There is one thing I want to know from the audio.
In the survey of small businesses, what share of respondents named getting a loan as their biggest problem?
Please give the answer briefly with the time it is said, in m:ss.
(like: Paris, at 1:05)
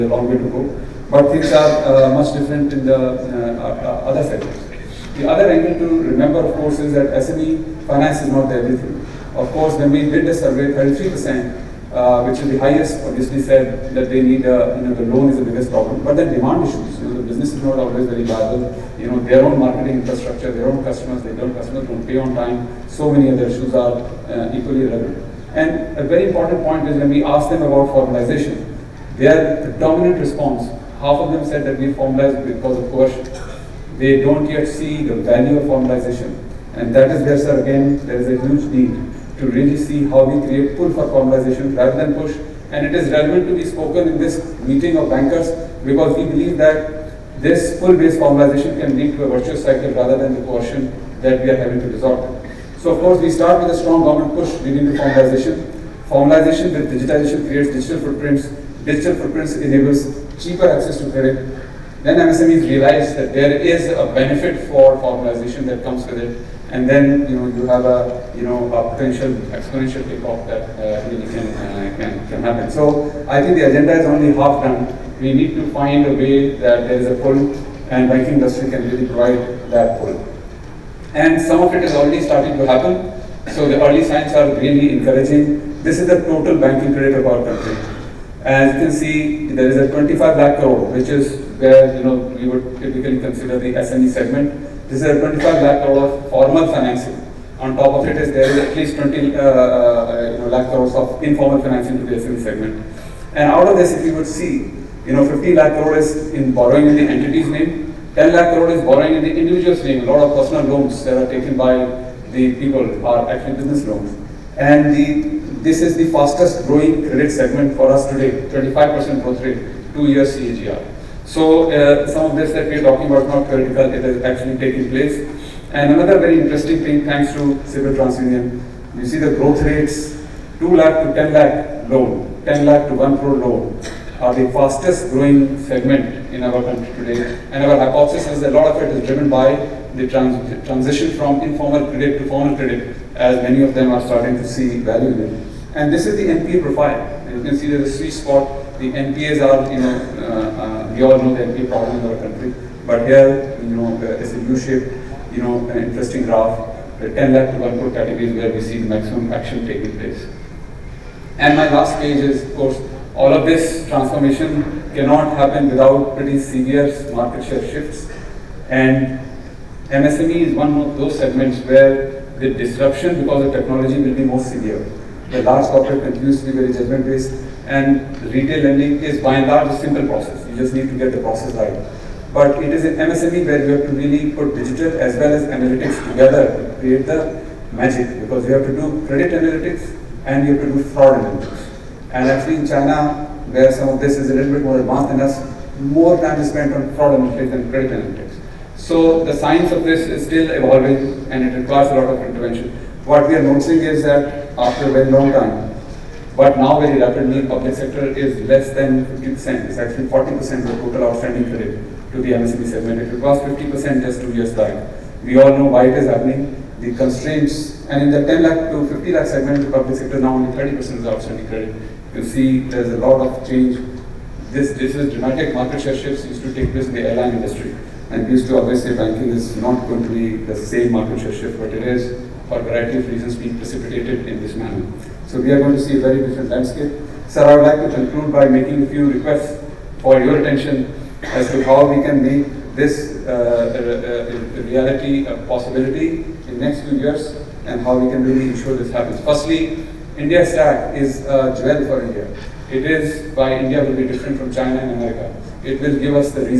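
33%, at 0:10.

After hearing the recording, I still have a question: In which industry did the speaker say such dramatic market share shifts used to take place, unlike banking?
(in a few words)
Airline industry.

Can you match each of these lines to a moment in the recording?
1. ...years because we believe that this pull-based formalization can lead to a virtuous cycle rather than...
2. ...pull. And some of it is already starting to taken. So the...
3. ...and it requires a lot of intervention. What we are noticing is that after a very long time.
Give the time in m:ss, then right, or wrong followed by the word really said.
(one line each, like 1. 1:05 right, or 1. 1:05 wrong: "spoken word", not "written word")
1. 0:45 wrong: "bankers", not "years"
2. 1:20 wrong: "happen", not "taken"
3. 3:21 right.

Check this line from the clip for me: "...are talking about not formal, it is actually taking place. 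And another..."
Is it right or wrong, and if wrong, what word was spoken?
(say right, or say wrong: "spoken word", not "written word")
wrong: "theoretical", not "formal".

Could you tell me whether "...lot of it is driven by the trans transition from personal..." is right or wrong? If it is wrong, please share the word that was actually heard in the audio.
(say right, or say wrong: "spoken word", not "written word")
wrong: "informal", not "personal".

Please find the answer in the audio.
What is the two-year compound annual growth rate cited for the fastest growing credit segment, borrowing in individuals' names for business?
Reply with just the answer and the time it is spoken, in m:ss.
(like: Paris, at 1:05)
25%, at 1:58.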